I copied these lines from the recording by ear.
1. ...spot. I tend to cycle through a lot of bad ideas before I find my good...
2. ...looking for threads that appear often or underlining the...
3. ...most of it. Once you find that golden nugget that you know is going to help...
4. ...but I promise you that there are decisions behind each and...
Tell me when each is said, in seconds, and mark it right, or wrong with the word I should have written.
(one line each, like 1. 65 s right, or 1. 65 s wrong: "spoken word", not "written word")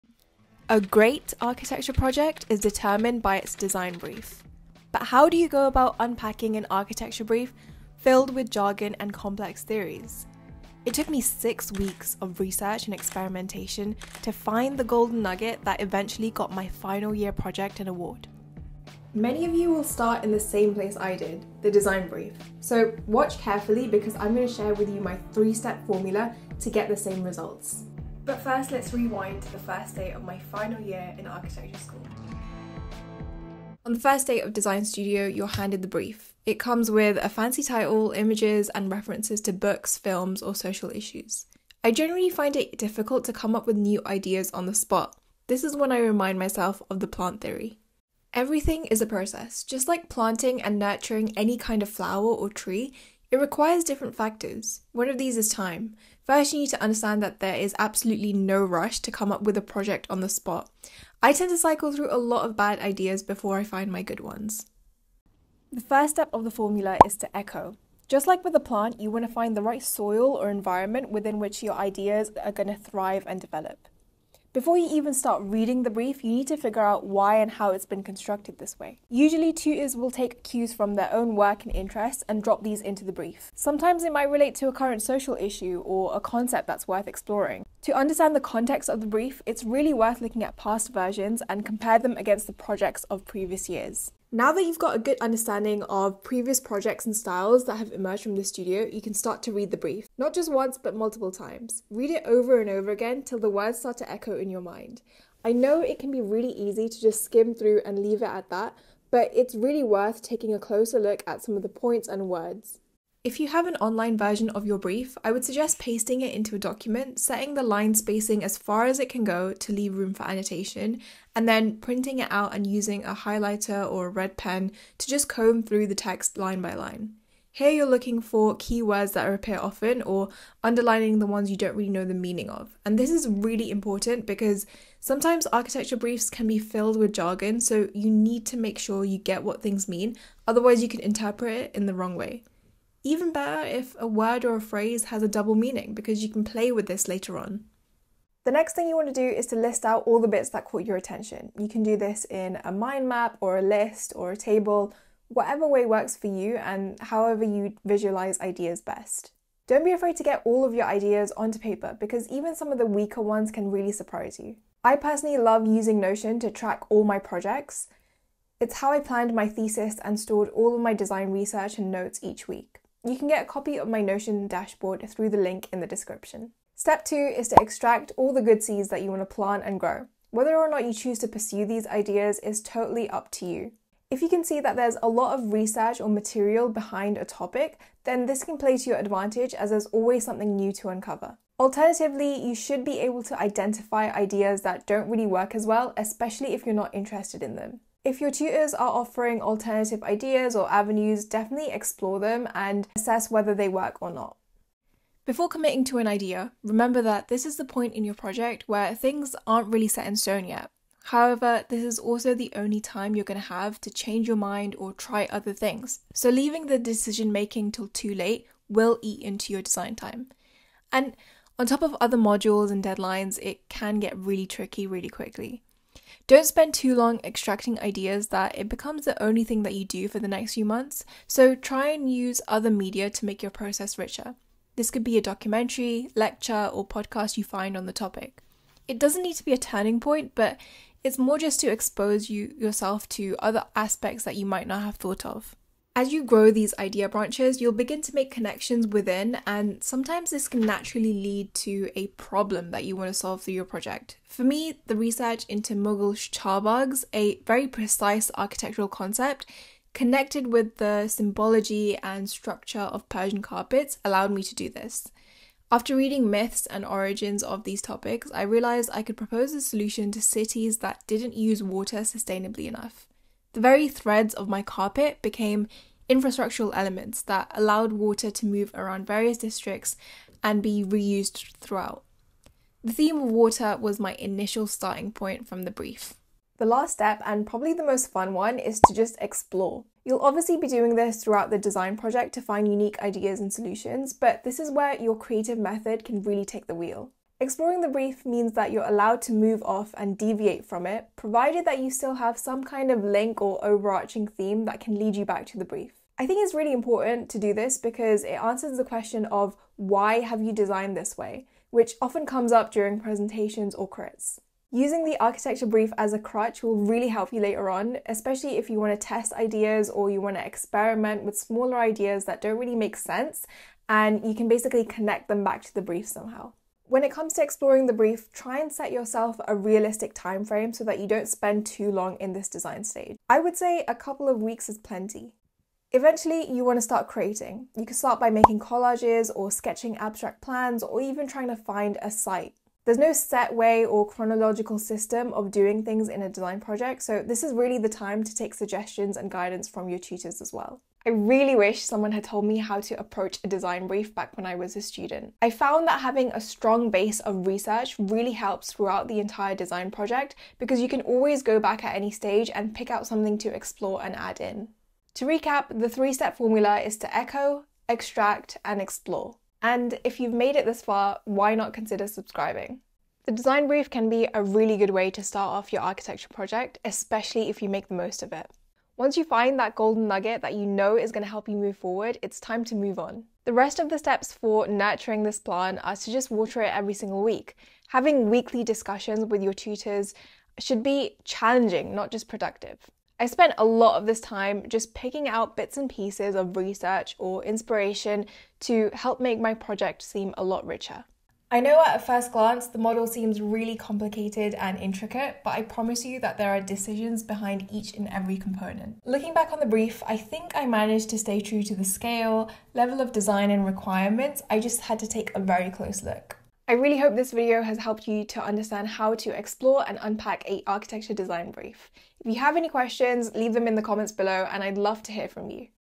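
1. 60 s right
2. 127 s wrong: "keywords", not "threads"
3. 377 s right
4. 405 s right.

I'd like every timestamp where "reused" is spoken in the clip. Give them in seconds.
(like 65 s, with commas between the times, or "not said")
280 s.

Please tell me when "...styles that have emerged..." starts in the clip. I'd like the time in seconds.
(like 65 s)
97 s.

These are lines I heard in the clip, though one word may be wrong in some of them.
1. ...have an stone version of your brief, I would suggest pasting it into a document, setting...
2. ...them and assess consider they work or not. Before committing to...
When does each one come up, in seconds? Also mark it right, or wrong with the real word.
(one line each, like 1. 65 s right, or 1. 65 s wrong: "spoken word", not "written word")
1. 113 s wrong: "online", not "stone"
2. 202 s wrong: "whether", not "consider".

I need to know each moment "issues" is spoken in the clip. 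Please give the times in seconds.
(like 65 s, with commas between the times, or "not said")
40 s, 85 s.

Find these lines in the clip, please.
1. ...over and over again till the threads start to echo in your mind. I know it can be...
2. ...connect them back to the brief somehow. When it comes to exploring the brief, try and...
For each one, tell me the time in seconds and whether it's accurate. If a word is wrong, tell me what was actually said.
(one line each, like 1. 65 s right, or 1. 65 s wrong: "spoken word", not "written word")
1. 102 s wrong: "words", not "threads"
2. 324 s right.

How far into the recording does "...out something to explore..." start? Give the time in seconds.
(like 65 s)
362 s.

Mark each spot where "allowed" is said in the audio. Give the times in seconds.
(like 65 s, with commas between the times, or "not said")
264 s, 277 s, 298 s.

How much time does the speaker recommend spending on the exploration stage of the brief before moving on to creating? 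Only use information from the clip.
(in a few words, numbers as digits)
a couple of weeks.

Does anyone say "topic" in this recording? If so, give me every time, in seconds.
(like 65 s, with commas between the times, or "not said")
187 s, 237 s, 267 s.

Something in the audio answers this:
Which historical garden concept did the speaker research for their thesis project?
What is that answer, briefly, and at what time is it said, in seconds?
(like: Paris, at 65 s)
Mughal baghs, at 255 s.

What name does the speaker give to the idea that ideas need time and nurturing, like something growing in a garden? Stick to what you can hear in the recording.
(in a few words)
plant theory.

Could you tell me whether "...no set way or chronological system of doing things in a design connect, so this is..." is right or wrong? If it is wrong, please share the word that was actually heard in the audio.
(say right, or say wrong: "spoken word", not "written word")
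wrong: "project", not "connect".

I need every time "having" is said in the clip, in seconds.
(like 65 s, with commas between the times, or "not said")
355 s, 387 s.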